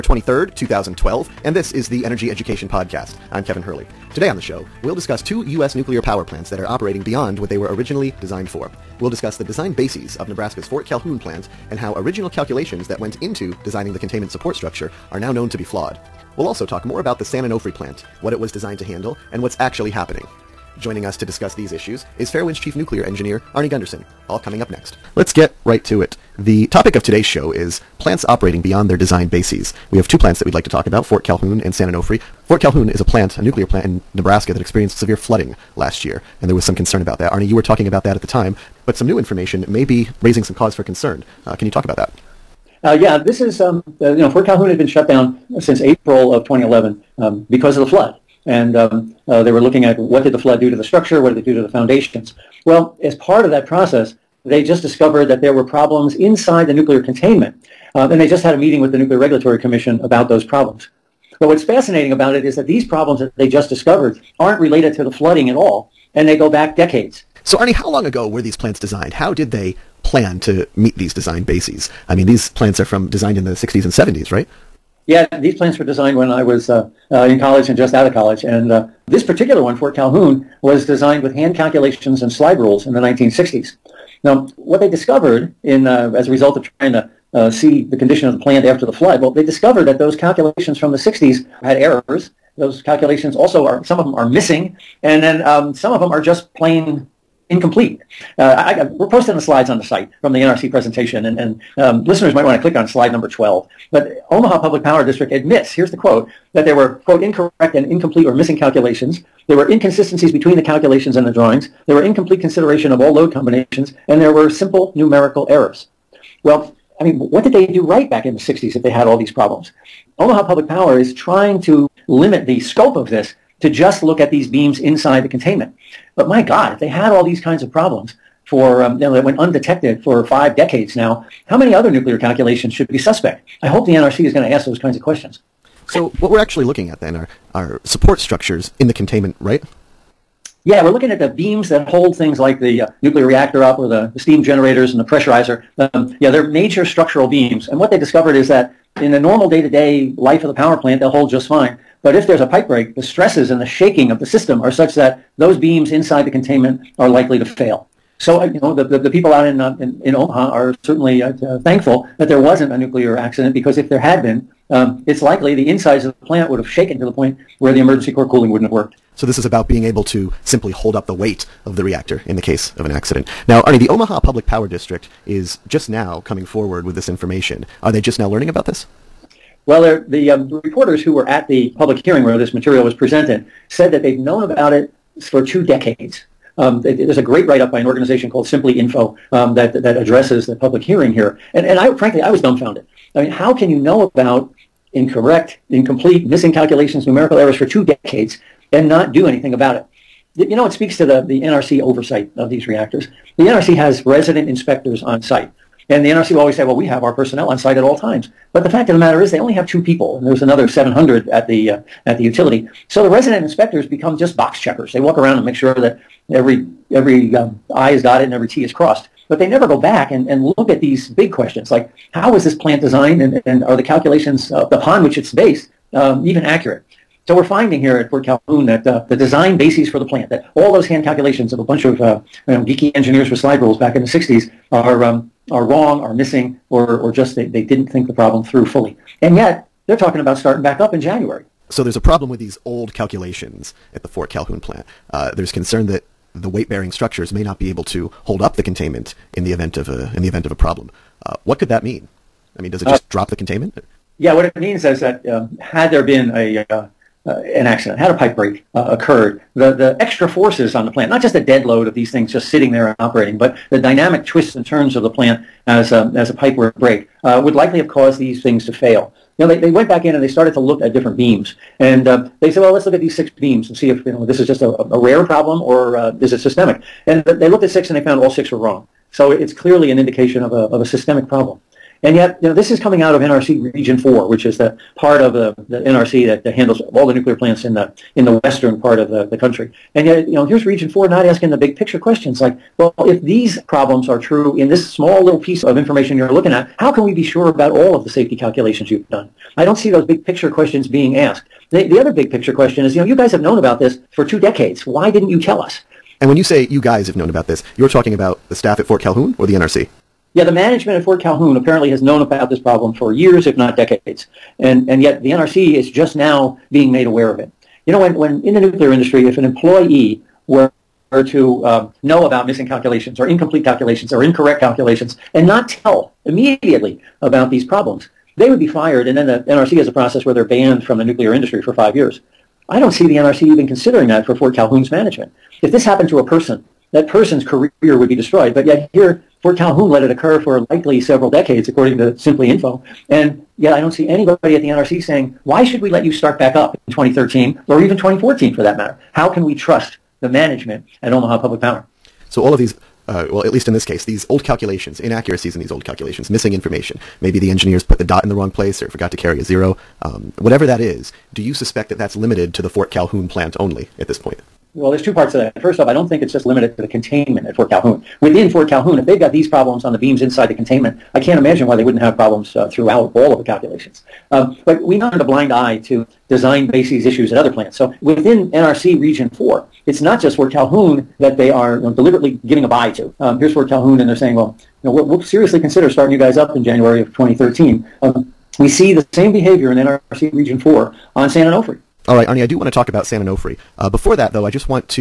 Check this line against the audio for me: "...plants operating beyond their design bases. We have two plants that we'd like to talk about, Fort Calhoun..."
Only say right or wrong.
right.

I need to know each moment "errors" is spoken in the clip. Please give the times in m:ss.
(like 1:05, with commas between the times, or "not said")
1:31, 1:55, 3:17.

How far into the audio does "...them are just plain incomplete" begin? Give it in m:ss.
1:35.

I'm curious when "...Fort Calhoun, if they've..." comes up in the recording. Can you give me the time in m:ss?
6:08.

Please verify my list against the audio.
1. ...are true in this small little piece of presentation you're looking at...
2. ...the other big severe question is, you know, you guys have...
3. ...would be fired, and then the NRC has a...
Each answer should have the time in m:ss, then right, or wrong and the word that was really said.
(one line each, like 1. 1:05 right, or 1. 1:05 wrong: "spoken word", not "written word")
1. 4:54 wrong: "information", not "presentation"
2. 5:01 wrong: "picture", not "severe"
3. 5:28 right.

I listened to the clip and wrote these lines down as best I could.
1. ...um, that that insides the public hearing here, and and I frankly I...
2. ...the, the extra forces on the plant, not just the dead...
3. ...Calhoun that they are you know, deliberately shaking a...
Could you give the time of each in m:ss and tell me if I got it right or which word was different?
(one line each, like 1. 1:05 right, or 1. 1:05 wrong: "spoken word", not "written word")
1. 3:09 wrong: "addresses", not "insides"
2. 4:19 right
3. 6:20 wrong: "giving", not "shaking".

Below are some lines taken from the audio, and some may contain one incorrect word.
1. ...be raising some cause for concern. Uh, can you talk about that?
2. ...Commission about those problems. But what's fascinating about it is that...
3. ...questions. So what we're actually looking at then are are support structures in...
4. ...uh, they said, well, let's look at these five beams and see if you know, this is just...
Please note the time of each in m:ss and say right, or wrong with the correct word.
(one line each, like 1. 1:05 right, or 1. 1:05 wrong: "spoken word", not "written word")
1. 0:39 right
2. 0:59 right
3. 2:15 right
4. 4:32 wrong: "six", not "five".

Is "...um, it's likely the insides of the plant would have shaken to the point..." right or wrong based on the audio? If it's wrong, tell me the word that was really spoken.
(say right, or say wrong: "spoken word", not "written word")
right.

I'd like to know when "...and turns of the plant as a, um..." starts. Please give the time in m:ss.
4:24.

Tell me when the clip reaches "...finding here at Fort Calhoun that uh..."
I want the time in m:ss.
3:47.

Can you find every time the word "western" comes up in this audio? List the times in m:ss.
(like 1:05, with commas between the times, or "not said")
4:48.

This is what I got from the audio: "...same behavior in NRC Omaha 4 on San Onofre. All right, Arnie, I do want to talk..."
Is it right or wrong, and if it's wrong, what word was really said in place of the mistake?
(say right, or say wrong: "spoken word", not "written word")
wrong: "Region", not "Omaha".